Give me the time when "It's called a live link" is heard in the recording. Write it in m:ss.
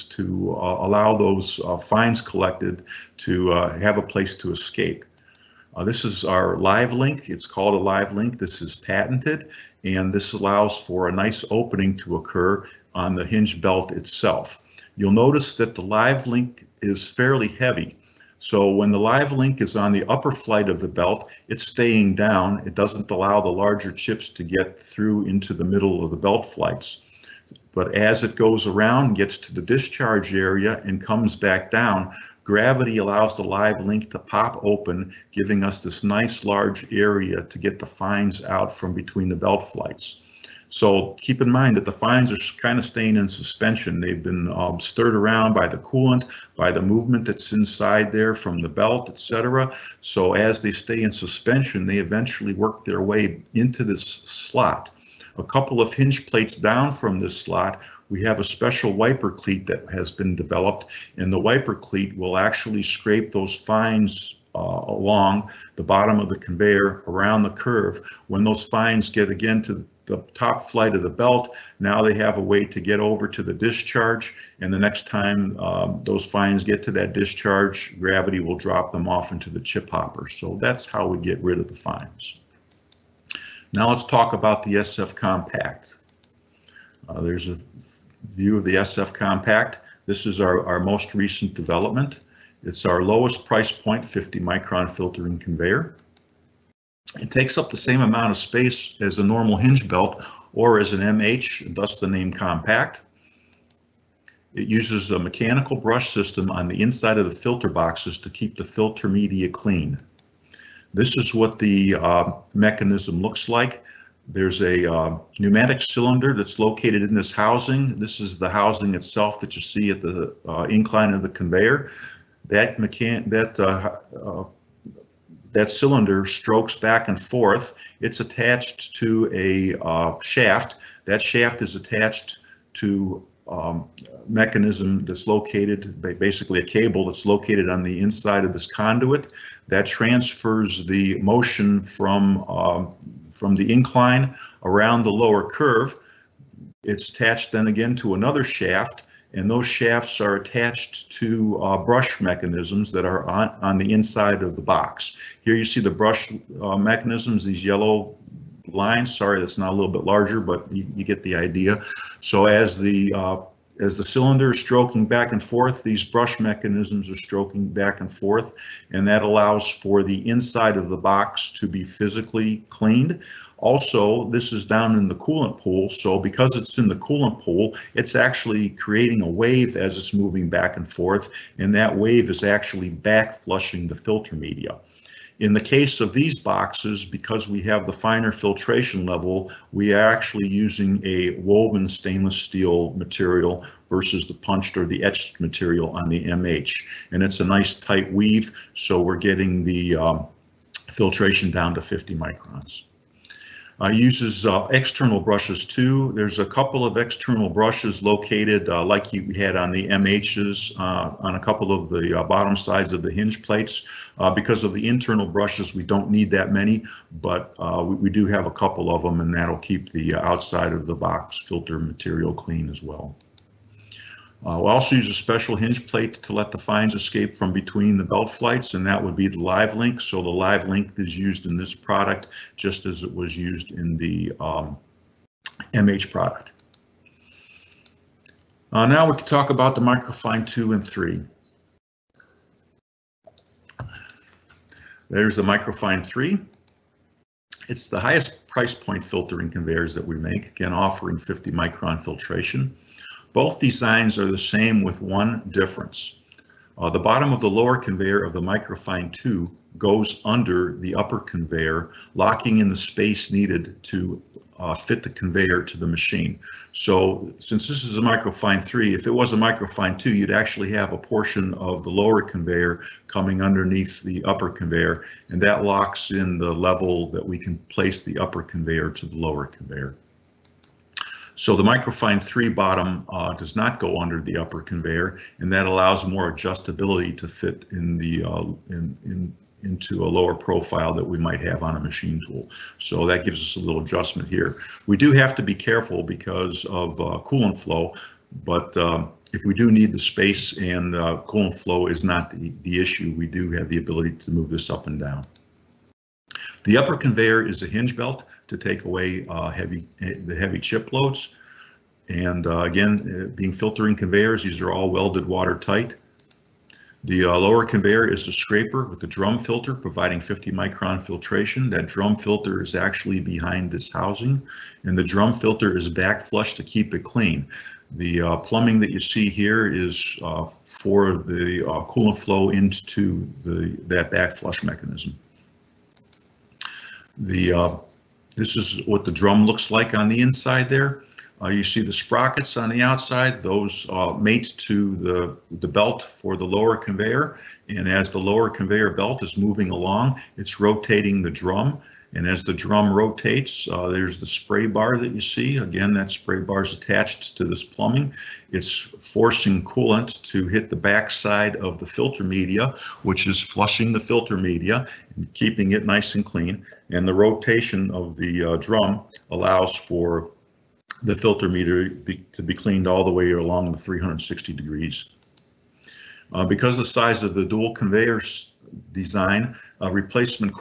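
0:07.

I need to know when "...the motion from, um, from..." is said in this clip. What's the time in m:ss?
2:20.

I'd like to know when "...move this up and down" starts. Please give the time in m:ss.
5:04.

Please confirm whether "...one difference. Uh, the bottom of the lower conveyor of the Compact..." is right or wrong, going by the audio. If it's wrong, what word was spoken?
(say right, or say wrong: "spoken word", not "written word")
wrong: "Microfine", not "Compact".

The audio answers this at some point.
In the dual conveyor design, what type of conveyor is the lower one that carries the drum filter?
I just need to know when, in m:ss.
5:18.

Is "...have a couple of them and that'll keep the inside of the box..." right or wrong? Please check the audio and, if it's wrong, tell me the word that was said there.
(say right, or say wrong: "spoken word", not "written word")
wrong: "outside", not "inside".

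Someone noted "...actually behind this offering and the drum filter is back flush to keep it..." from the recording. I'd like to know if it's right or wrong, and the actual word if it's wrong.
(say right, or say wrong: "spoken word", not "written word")
wrong: "housing", not "offering".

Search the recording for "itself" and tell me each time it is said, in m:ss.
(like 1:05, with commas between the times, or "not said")
0:13, 1:58.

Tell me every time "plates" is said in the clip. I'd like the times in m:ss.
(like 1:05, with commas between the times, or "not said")
0:56, 3:33, 3:45.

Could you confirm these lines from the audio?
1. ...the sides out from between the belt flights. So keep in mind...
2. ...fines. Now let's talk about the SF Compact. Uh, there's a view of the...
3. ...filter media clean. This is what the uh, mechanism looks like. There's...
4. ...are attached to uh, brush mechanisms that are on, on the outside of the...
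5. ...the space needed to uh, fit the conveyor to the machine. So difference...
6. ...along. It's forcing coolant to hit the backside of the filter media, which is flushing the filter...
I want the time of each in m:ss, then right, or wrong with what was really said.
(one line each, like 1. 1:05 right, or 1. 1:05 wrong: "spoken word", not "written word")
1. 0:37 wrong: "fines", not "sides"
2. 1:21 right
3. 1:48 right
4. 2:30 wrong: "inside", not "outside"
5. 4:22 wrong: "since", not "difference"
6. 5:57 wrong: "plumbing", not "along".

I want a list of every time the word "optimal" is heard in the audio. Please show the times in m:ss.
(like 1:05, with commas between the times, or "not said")
not said.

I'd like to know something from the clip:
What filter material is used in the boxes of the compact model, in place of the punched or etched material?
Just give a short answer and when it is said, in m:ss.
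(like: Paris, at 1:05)
woven stainless steel, at 3:11.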